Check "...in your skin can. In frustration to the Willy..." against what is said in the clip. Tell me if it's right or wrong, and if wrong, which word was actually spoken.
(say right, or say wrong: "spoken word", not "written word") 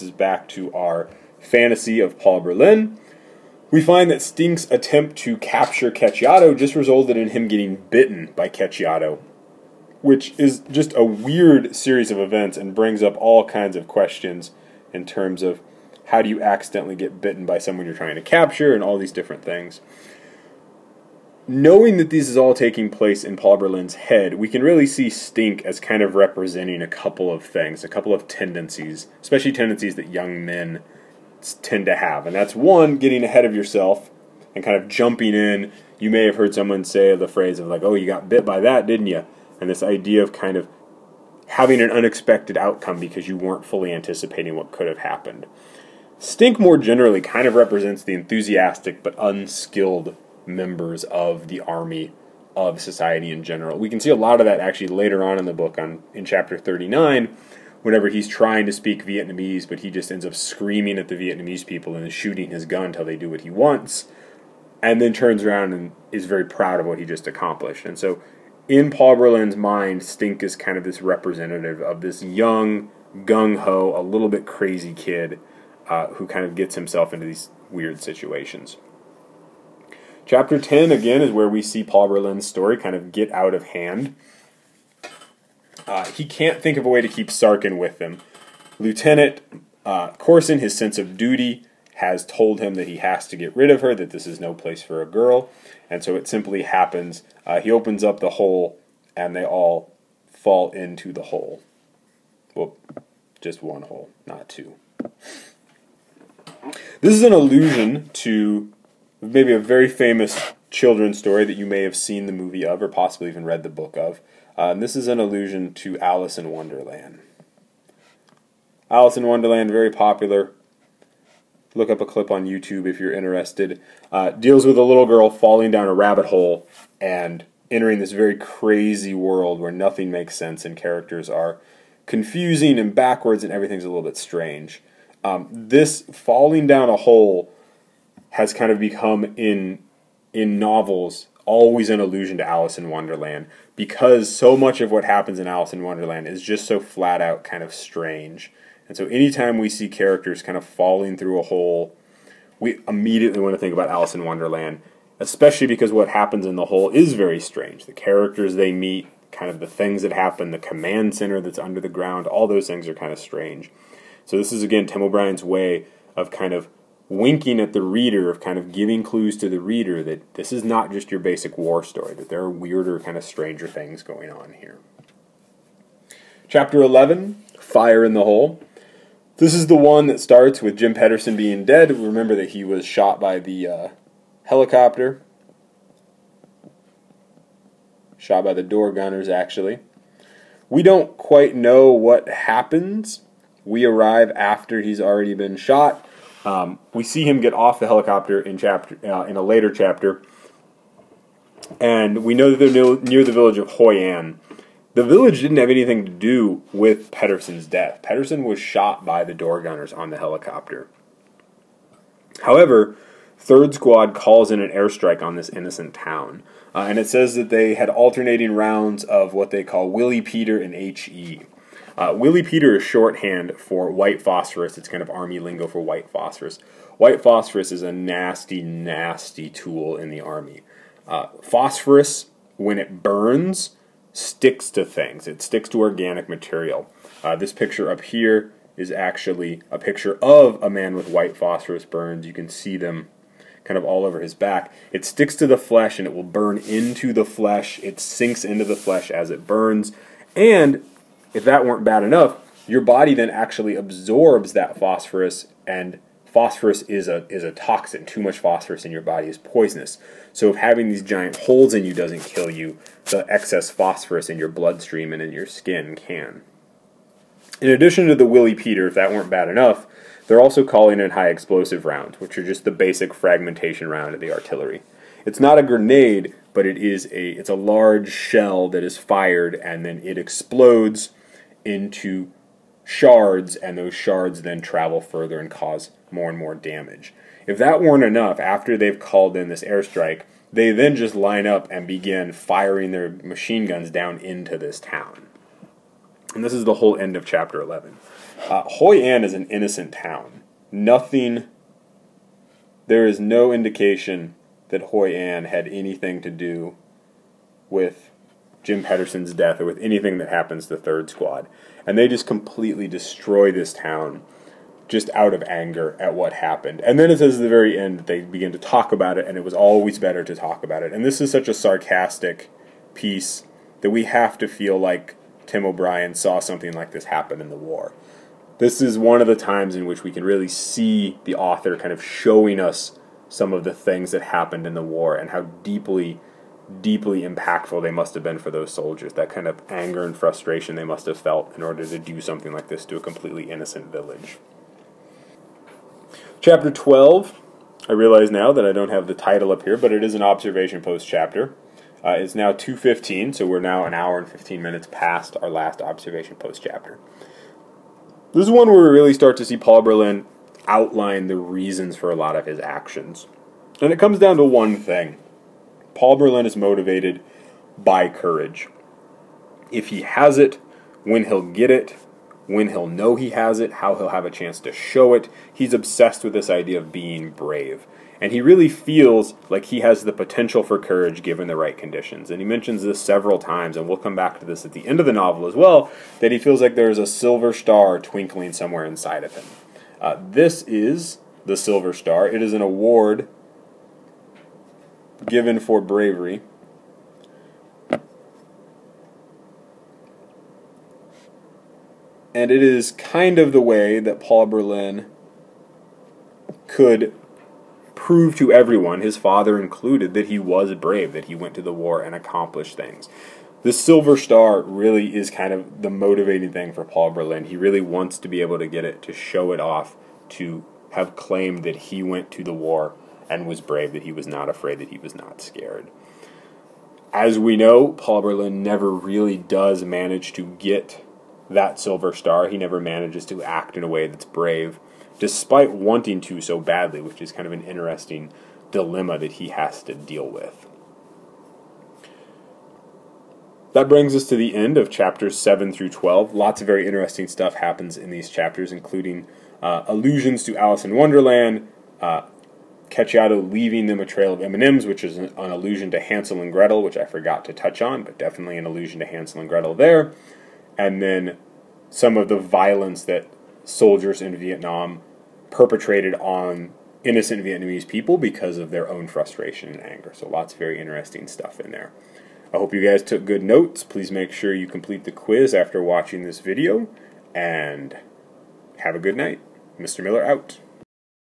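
wrong: "addition", not "frustration".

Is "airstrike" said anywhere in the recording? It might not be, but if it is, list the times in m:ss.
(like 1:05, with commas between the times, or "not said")
3:34, 4:49.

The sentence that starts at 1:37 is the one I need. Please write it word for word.
Uh, he opens up the hole, and they all fall into the hole.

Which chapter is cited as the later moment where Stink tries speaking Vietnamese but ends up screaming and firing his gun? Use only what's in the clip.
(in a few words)
39.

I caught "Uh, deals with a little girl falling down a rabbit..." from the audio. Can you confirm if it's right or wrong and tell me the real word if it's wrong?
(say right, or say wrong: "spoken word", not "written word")
right.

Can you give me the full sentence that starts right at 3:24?
The village didn't have anything to do with Pedersen's death.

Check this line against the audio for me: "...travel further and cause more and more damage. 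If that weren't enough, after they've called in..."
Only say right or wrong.
right.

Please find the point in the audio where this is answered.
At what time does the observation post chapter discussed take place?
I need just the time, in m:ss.
5:52.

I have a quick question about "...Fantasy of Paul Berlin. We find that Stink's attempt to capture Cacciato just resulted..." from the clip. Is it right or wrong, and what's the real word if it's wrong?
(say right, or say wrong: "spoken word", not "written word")
right.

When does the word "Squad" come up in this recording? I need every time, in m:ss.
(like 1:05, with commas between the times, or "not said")
3:33, 5:11.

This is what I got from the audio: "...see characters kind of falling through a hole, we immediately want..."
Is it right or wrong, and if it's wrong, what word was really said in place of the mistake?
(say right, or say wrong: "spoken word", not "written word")
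right.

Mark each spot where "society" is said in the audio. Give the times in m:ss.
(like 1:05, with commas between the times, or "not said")
0:52.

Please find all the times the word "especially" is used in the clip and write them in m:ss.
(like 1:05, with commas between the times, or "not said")
0:29, 2:35.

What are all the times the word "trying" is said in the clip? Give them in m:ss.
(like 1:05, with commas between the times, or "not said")
0:17, 0:58.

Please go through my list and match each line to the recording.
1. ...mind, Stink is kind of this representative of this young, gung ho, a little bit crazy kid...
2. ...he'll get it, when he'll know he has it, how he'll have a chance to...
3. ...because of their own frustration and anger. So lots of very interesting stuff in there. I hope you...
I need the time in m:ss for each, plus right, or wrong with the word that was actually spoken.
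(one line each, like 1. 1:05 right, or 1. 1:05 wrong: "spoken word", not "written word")
1. 1:09 right
2. 6:11 right
3. 7:48 right.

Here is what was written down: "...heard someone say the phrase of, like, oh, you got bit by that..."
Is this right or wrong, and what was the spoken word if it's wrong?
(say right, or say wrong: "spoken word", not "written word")
right.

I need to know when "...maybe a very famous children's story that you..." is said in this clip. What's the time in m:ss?
1:49.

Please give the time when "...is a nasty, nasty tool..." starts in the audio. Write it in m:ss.
3:47.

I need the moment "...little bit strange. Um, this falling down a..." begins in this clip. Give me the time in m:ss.
2:13.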